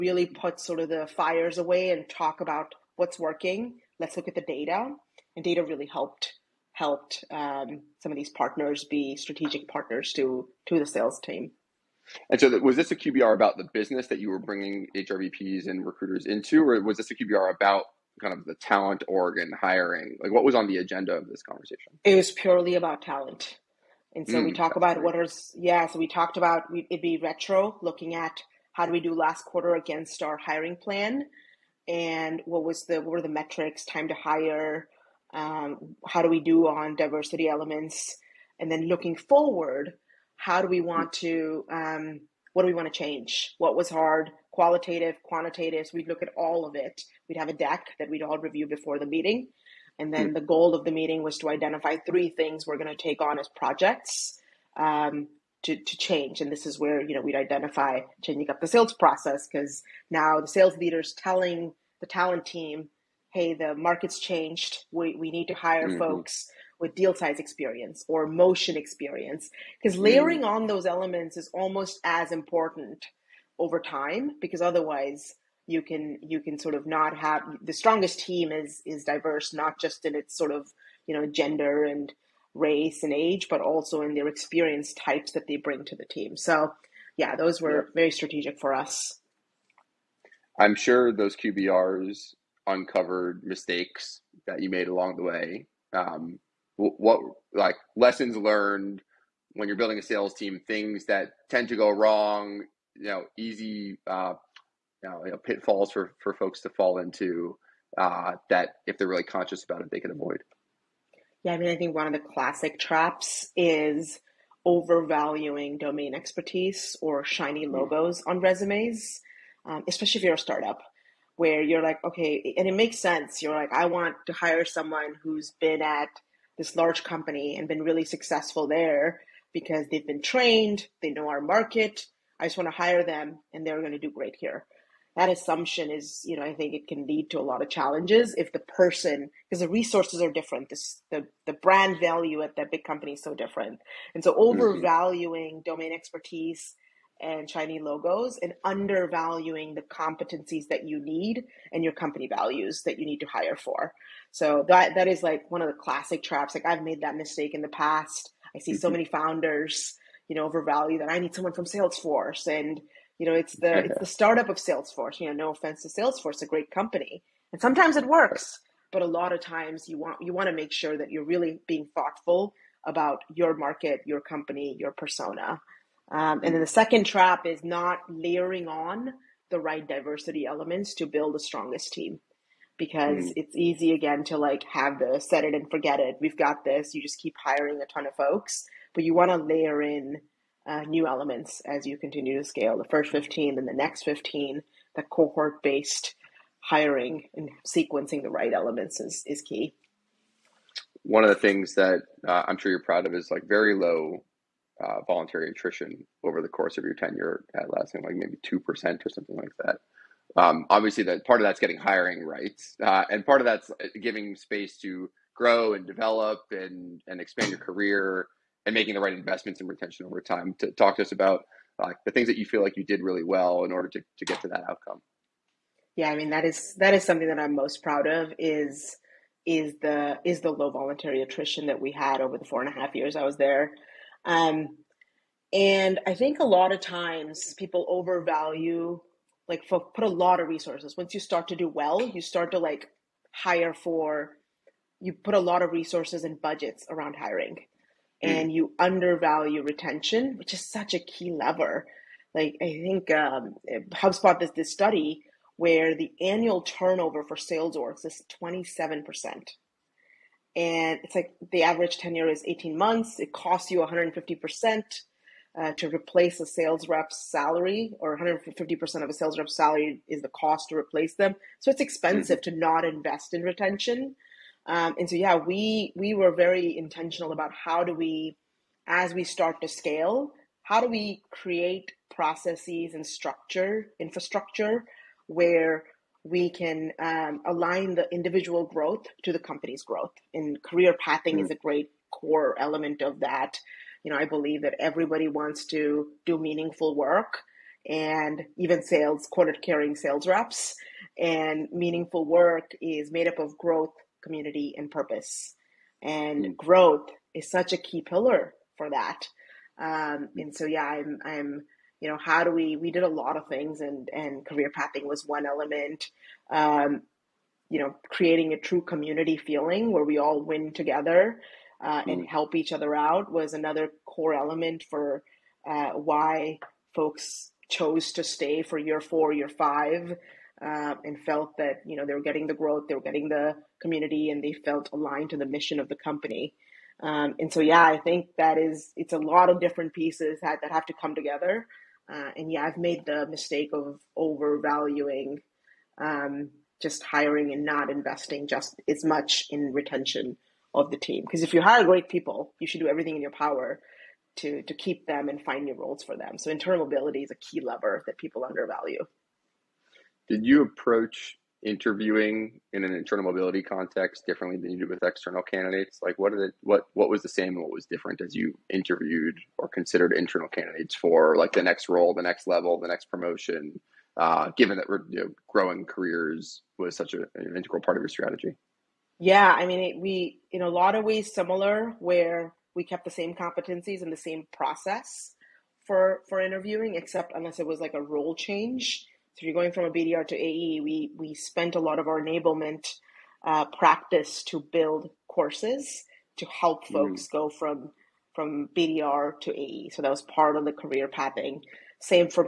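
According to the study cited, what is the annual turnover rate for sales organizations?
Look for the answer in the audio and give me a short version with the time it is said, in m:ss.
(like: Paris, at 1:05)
27%, at 4:18.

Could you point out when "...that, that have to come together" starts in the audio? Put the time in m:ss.
5:40.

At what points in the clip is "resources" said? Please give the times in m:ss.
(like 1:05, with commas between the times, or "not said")
2:19, 4:00, 4:05.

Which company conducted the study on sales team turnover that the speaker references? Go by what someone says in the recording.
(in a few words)
HubSpot.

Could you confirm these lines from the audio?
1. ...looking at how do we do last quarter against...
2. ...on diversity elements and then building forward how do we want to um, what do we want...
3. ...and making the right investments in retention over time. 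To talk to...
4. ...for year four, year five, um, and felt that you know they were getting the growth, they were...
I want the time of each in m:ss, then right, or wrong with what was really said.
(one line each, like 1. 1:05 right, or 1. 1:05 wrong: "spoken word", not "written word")
1. 0:27 right
2. 0:36 wrong: "looking", not "building"
3. 3:38 right
4. 5:28 right.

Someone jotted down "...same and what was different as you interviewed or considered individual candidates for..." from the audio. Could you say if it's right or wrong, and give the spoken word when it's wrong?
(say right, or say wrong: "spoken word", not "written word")
wrong: "internal", not "individual".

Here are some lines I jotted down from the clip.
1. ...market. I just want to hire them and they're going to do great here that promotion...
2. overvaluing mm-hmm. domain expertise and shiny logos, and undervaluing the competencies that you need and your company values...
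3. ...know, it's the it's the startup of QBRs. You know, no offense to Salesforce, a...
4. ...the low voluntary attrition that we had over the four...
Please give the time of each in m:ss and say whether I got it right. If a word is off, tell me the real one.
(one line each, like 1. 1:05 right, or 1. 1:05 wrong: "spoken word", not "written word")
1. 2:11 wrong: "assumption", not "promotion"
2. 2:24 right
3. 2:43 wrong: "Salesforce", not "QBRs"
4. 3:50 right.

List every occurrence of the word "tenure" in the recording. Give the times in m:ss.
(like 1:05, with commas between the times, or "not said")
3:26, 4:21.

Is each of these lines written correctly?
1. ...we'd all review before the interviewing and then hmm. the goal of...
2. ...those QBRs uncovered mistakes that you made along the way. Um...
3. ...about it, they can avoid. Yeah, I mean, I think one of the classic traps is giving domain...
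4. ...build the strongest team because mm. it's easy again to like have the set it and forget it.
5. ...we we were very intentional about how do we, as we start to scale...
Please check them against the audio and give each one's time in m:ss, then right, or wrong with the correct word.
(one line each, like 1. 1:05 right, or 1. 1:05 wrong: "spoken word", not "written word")
1. 0:48 wrong: "meeting", not "interviewing"
2. 1:31 right
3. 1:49 wrong: "overvaluing", not "giving"
4. 3:01 right
5. 4:35 right.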